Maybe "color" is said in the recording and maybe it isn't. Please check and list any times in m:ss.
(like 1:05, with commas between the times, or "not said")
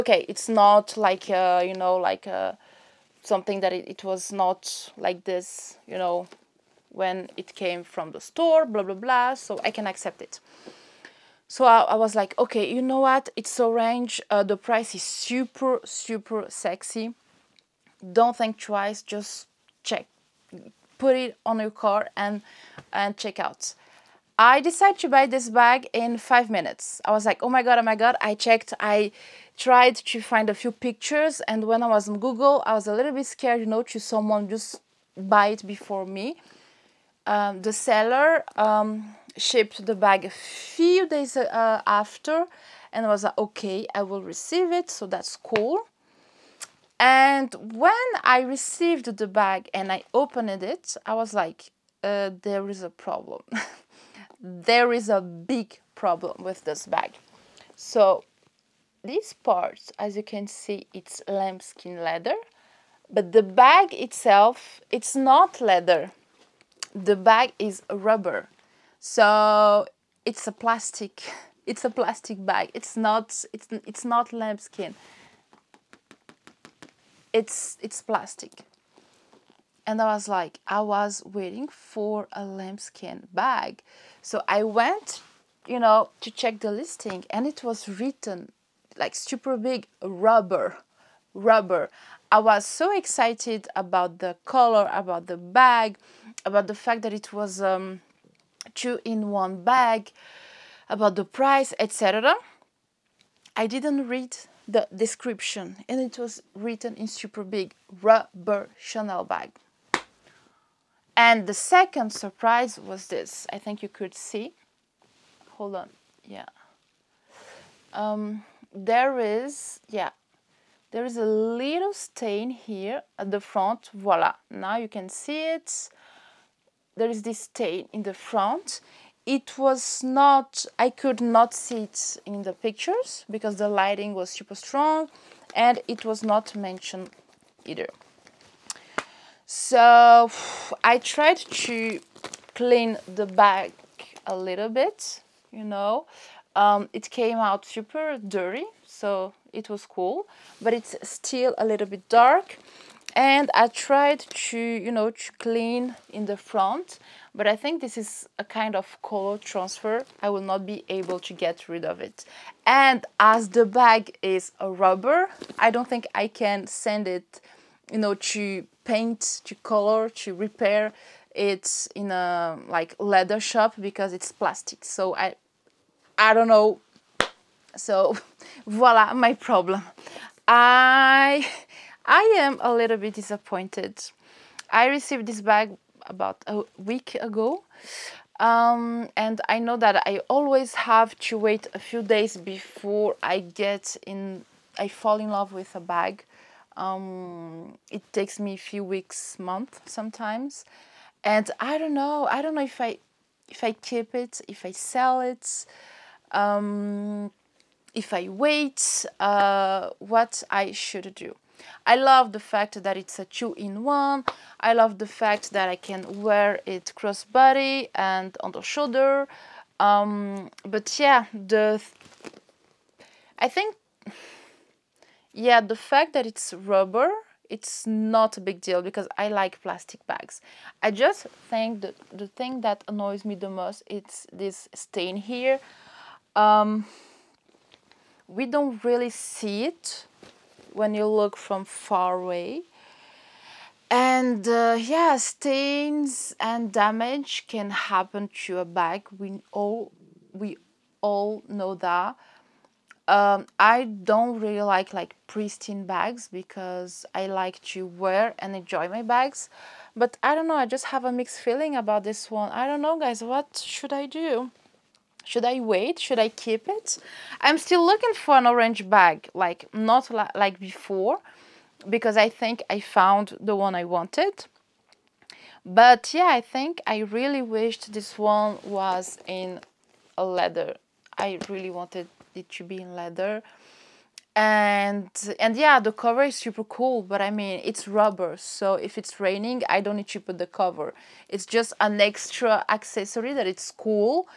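1:34, 2:39, 2:49.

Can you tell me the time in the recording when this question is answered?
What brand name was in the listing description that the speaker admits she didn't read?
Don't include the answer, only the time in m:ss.
1:48.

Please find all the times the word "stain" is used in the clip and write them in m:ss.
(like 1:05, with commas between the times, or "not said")
2:01, 2:07, 3:54, 4:05.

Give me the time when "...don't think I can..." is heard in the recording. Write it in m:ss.
2:45.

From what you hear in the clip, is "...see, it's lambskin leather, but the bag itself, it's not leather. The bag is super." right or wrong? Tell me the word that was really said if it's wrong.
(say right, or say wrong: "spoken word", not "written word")
wrong: "rubber", not "super".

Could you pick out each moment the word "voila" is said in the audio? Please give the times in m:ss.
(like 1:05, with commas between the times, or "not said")
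2:03, 2:58.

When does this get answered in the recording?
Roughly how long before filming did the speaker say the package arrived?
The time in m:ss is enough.
3:06.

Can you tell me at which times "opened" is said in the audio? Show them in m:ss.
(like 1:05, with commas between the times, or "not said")
0:50.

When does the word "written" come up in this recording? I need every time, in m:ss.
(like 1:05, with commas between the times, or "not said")
1:27, 1:46.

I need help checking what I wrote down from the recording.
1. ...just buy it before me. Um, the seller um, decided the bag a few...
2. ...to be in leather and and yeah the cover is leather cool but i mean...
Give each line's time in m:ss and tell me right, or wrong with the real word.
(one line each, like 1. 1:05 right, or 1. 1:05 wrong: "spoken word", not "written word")
1. 0:34 wrong: "shipped", not "decided"
2. 4:42 wrong: "super", not "leather".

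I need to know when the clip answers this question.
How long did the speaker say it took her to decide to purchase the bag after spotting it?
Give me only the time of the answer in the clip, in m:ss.
0:26.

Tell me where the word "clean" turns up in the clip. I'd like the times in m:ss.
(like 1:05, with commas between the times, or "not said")
2:22, 2:35.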